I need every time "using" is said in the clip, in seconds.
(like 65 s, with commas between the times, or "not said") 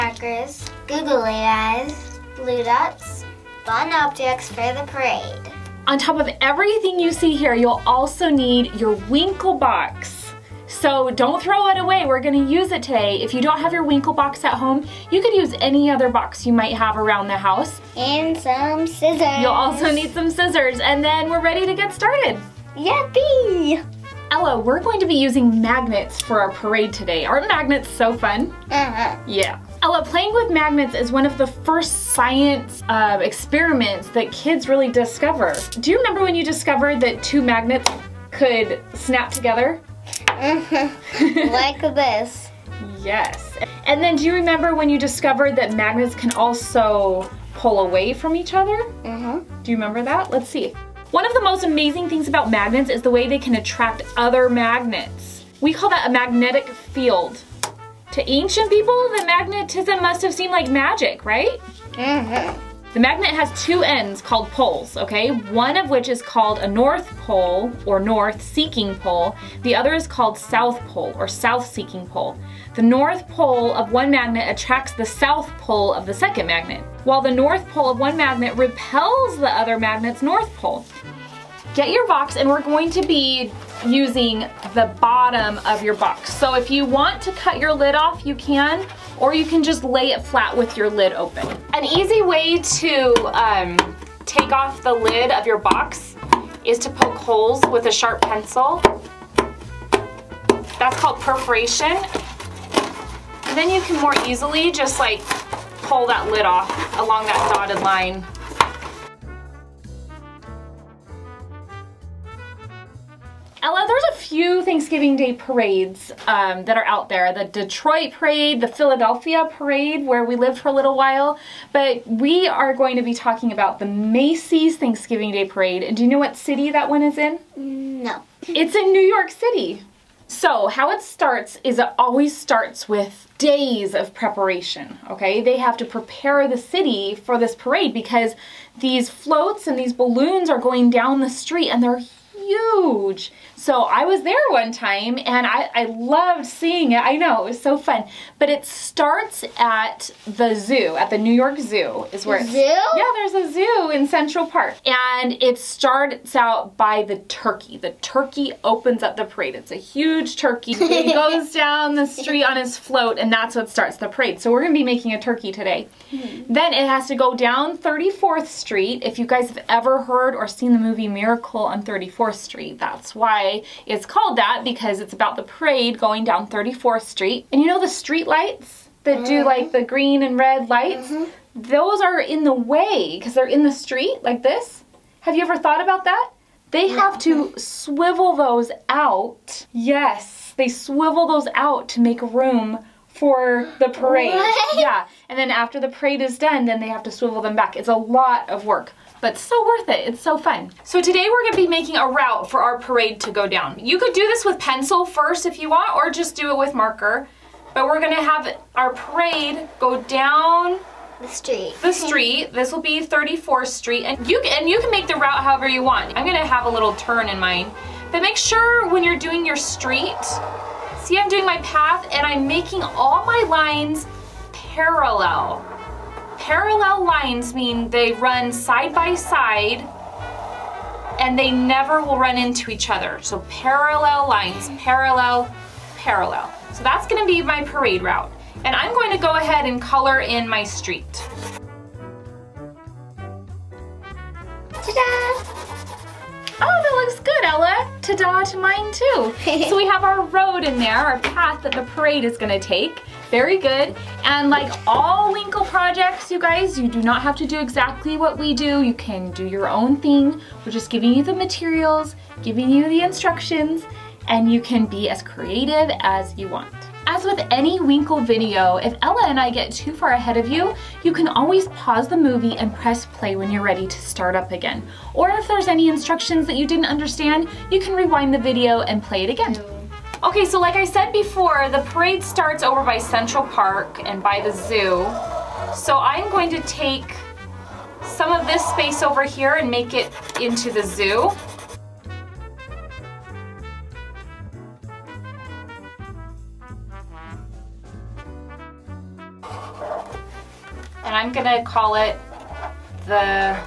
25 s, 83 s.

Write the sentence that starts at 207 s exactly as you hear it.
But we're gonna have our parade go down the street.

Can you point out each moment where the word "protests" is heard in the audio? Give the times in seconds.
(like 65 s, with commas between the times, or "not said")
not said.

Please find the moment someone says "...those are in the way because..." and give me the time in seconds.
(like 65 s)
181 s.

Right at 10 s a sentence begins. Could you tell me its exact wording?
So don't throw it away, we're gonna use it today.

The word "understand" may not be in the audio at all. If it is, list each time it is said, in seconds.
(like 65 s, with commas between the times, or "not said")
276 s.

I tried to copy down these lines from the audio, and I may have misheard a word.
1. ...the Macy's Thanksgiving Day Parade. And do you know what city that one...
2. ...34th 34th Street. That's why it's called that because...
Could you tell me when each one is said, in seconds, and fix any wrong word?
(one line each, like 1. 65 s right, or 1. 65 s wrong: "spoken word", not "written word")
1. 123 s right
2. 171 s right.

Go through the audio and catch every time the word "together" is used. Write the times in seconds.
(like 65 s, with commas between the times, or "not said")
39 s.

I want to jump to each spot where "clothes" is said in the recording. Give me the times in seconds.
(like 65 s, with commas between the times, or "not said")
not said.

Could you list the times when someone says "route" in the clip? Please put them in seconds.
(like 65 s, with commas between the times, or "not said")
202 s, 215 s, 238 s.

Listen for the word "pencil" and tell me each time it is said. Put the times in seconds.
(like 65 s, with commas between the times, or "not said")
98 s, 204 s.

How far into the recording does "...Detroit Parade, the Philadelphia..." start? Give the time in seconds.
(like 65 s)
117 s.